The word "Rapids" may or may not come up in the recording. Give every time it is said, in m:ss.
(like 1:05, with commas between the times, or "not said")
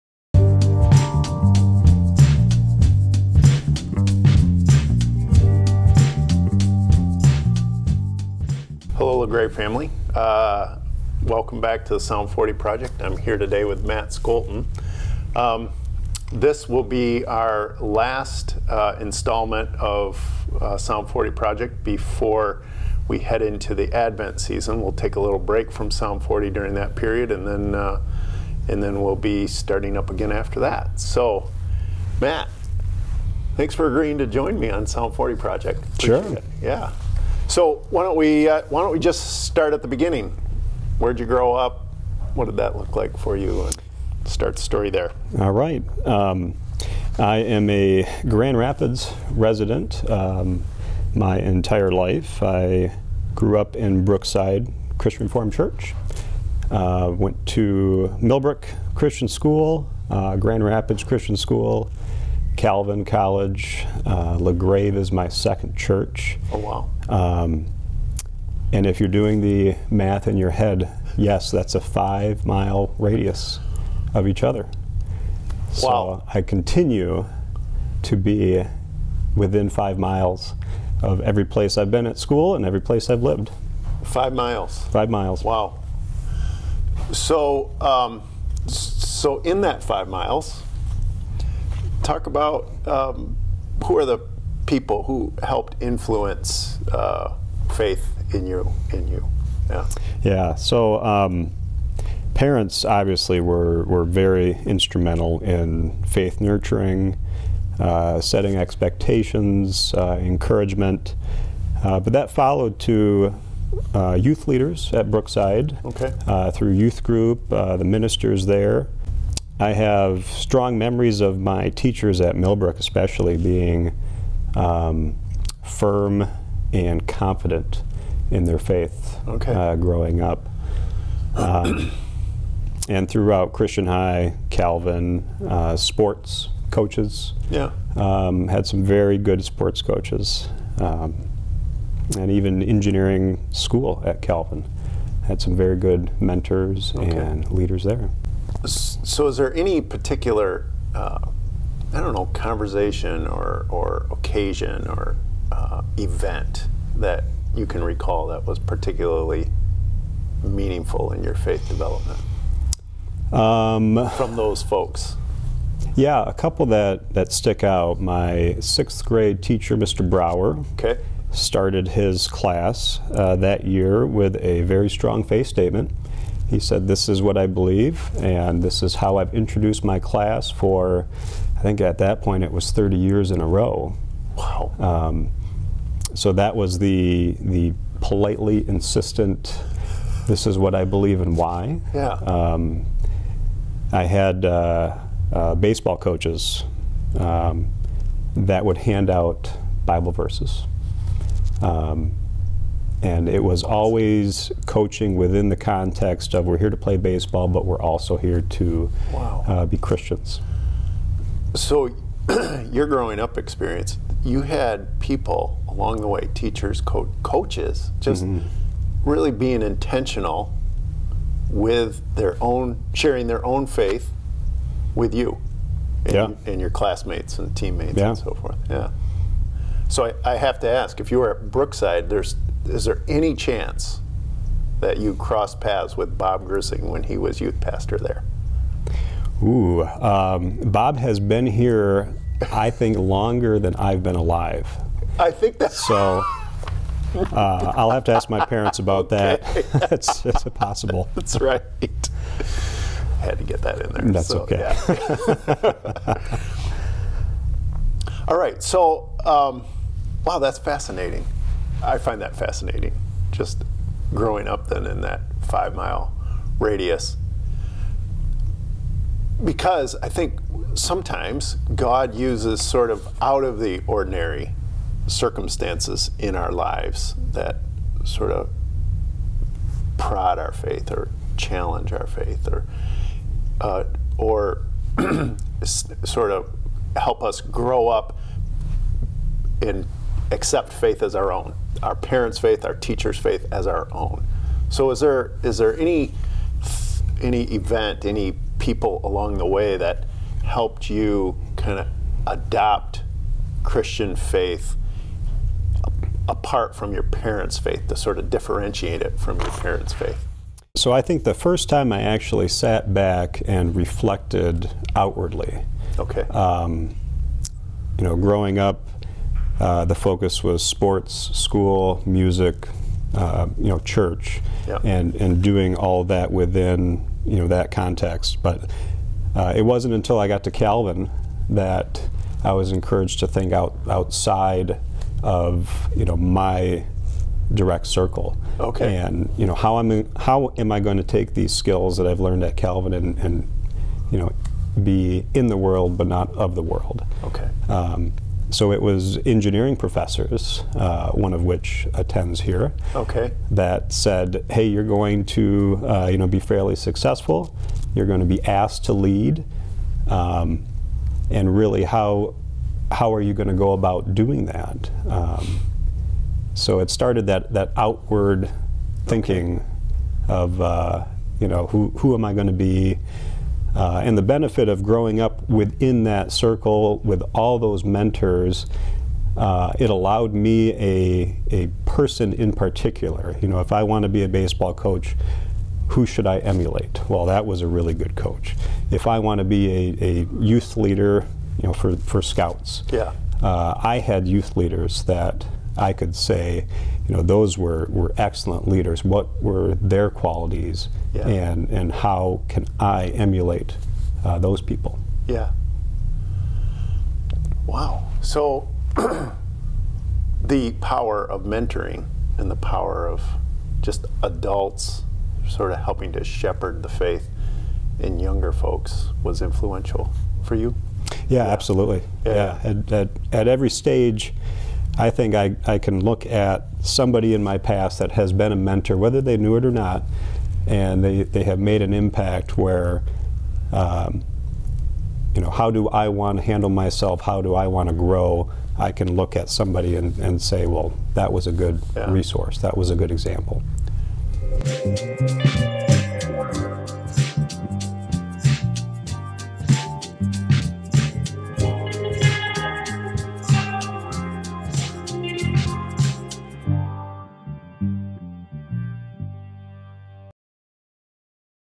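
0:48, 1:00.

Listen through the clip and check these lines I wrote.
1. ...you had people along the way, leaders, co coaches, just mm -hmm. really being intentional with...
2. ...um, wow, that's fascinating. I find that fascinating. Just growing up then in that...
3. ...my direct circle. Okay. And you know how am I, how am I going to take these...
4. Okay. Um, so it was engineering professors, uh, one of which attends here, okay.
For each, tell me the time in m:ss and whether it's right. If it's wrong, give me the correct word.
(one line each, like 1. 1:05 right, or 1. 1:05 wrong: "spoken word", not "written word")
1. 3:34 wrong: "teachers", not "leaders"
2. 4:19 right
3. 5:36 right
4. 5:47 right.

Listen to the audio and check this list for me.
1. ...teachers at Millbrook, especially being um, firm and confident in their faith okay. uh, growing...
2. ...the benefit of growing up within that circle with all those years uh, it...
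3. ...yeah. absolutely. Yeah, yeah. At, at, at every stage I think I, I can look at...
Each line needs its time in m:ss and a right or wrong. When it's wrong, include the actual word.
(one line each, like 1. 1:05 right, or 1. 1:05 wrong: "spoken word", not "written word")
1. 2:01 right
2. 6:14 wrong: "mentors", not "years"
3. 7:01 right.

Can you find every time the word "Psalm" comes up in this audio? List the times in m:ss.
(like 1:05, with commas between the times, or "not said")
0:12, 0:20, 0:25, 0:34.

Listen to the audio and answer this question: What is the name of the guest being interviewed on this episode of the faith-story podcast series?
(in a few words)
Matt Scholten.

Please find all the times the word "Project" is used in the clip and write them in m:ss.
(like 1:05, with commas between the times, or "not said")
0:12, 0:21, 0:35.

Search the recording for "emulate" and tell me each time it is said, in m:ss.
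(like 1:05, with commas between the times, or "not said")
6:26, 6:43.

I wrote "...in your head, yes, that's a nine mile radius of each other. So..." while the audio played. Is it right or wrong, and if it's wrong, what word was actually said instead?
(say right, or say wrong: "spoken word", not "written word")
wrong: "five", not "nine".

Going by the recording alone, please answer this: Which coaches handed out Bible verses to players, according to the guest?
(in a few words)
Baseball coaches.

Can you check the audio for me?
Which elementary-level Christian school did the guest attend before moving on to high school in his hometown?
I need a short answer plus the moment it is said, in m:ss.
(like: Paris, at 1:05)
Millbrook Christian School, at 0:58.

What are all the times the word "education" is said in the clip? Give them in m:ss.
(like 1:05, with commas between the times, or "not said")
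not said.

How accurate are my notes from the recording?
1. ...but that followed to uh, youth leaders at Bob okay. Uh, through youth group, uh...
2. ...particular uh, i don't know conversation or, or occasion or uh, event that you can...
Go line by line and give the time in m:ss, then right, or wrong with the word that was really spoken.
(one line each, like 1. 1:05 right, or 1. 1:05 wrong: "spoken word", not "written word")
1. 1:51 wrong: "Brookside", not "Bob"
2. 2:29 right.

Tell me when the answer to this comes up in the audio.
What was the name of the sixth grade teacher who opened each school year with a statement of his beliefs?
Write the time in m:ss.
2:49.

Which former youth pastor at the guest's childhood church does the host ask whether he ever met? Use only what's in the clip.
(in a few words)
Bob Grising.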